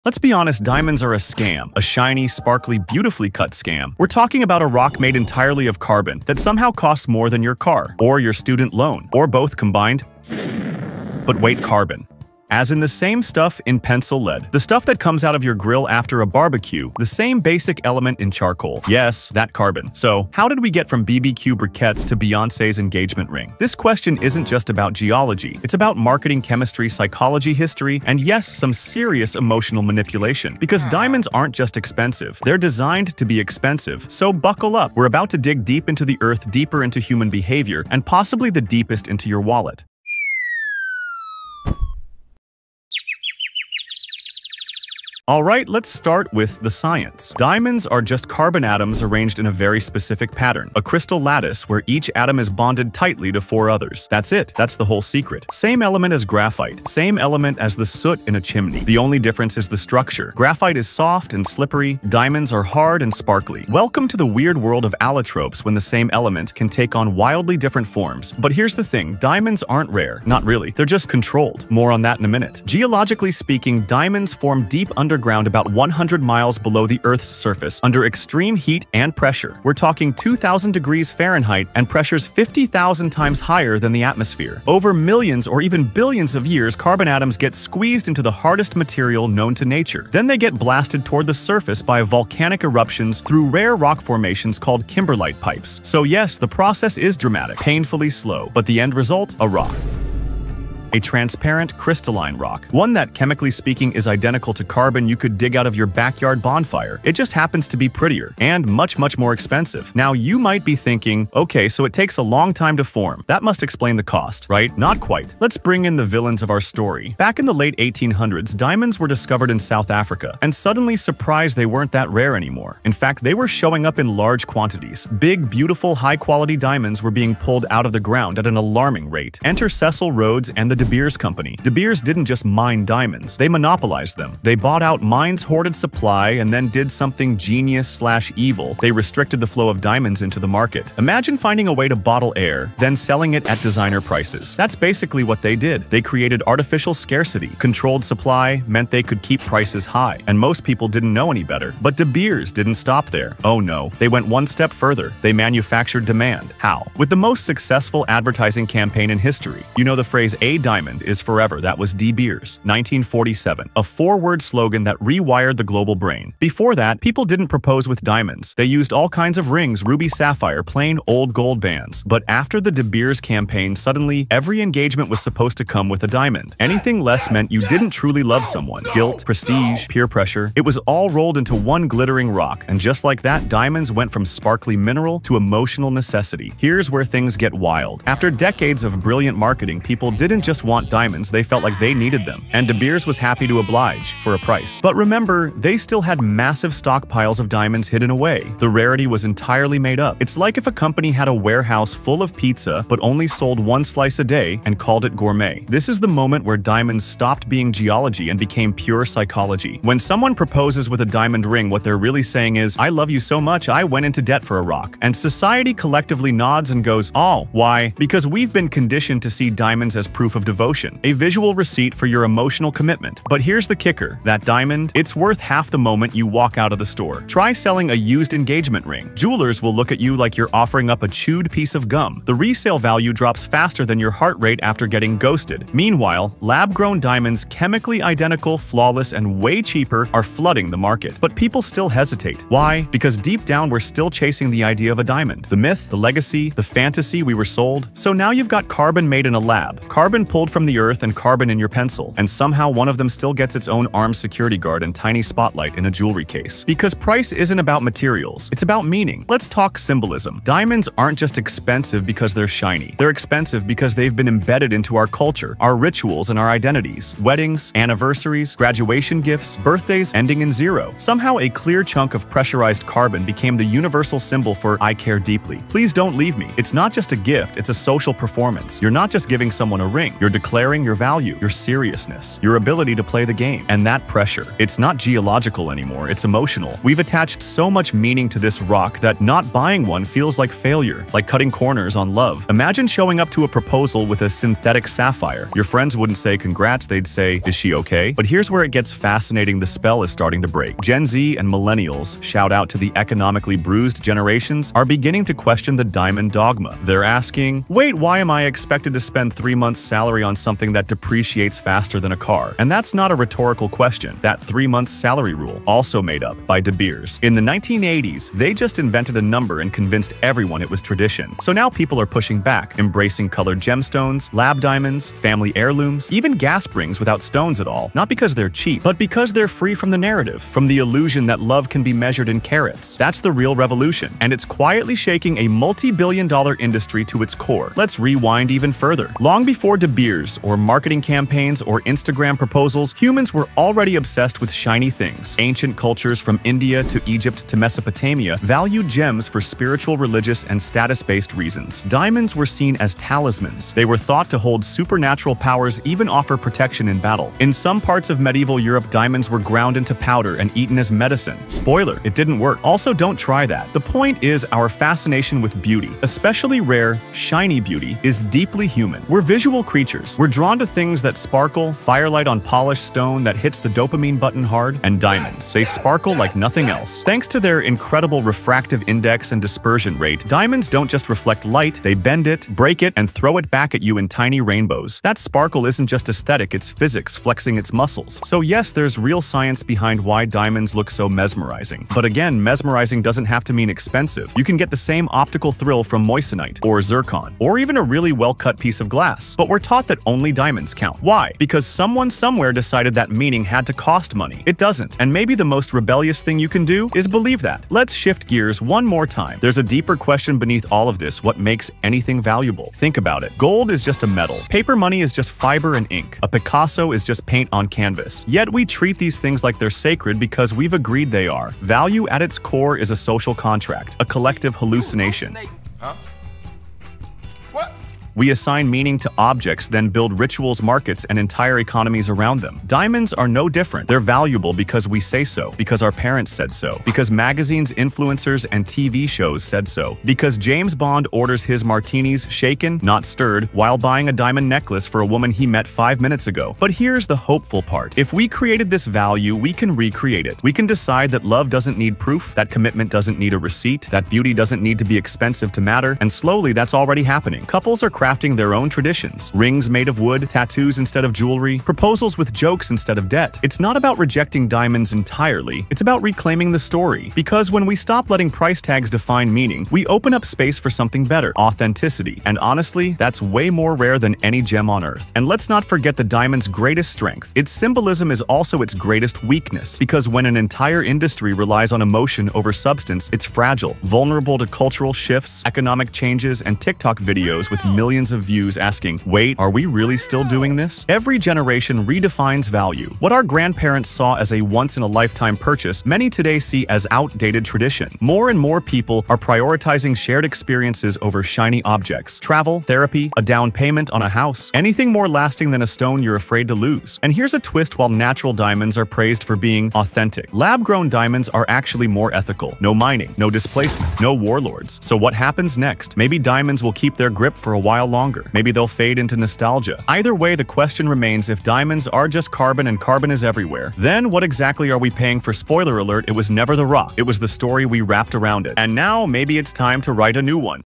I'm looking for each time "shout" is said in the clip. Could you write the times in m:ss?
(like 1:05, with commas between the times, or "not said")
5:02.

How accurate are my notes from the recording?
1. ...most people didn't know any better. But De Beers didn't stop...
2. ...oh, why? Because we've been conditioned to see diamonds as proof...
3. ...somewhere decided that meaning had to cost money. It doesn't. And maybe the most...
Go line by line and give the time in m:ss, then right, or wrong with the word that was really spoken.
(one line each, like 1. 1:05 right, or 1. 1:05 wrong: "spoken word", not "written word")
1. 2:30 right
2. 3:37 right
3. 6:42 right.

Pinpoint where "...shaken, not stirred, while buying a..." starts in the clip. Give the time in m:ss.
7:22.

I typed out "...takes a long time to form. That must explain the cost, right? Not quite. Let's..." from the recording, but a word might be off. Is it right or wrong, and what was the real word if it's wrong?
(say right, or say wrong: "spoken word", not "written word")
right.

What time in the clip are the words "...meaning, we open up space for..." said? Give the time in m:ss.
7:49.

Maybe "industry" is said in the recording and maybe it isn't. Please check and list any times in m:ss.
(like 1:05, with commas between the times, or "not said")
5:36, 8:00.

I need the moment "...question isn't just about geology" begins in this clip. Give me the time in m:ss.
0:23.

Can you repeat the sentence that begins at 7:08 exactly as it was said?
We assign meaning to objects, then build rituals, markets, and entire economies around them.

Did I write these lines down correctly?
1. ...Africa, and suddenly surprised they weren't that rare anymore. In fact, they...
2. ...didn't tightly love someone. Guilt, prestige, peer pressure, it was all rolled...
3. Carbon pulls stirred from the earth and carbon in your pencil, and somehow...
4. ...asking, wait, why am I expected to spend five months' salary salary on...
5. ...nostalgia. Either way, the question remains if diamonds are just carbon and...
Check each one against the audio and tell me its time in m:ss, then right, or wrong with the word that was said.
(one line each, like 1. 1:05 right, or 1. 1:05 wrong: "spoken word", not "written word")
1. 1:59 right
2. 2:57 wrong: "truly", not "tightly"
3. 4:09 wrong: "pulled", not "stirred"
4. 5:07 wrong: "three", not "five"
5. 8:39 right.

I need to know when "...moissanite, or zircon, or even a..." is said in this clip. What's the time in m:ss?
6:36.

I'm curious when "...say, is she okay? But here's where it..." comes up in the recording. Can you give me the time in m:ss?
4:57.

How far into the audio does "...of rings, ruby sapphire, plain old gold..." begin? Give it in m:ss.
2:49.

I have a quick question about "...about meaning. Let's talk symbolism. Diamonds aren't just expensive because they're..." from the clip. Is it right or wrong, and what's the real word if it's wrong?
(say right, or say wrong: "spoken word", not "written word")
right.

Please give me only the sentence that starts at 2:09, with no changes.
Enter Cecil Rhodes and the De Beers Company.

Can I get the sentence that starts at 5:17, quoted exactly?
In the 1980s, they just invented a number and convinced everyone it was tradition.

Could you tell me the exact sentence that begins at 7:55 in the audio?
And let's not forget the diamond's greatest strength.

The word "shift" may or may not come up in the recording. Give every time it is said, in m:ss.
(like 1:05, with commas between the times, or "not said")
6:47, 8:04.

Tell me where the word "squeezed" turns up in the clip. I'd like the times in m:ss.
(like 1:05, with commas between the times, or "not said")
1:27.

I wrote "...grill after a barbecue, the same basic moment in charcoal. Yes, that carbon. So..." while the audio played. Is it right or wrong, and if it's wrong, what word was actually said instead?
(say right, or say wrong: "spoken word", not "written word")
wrong: "element", not "moment".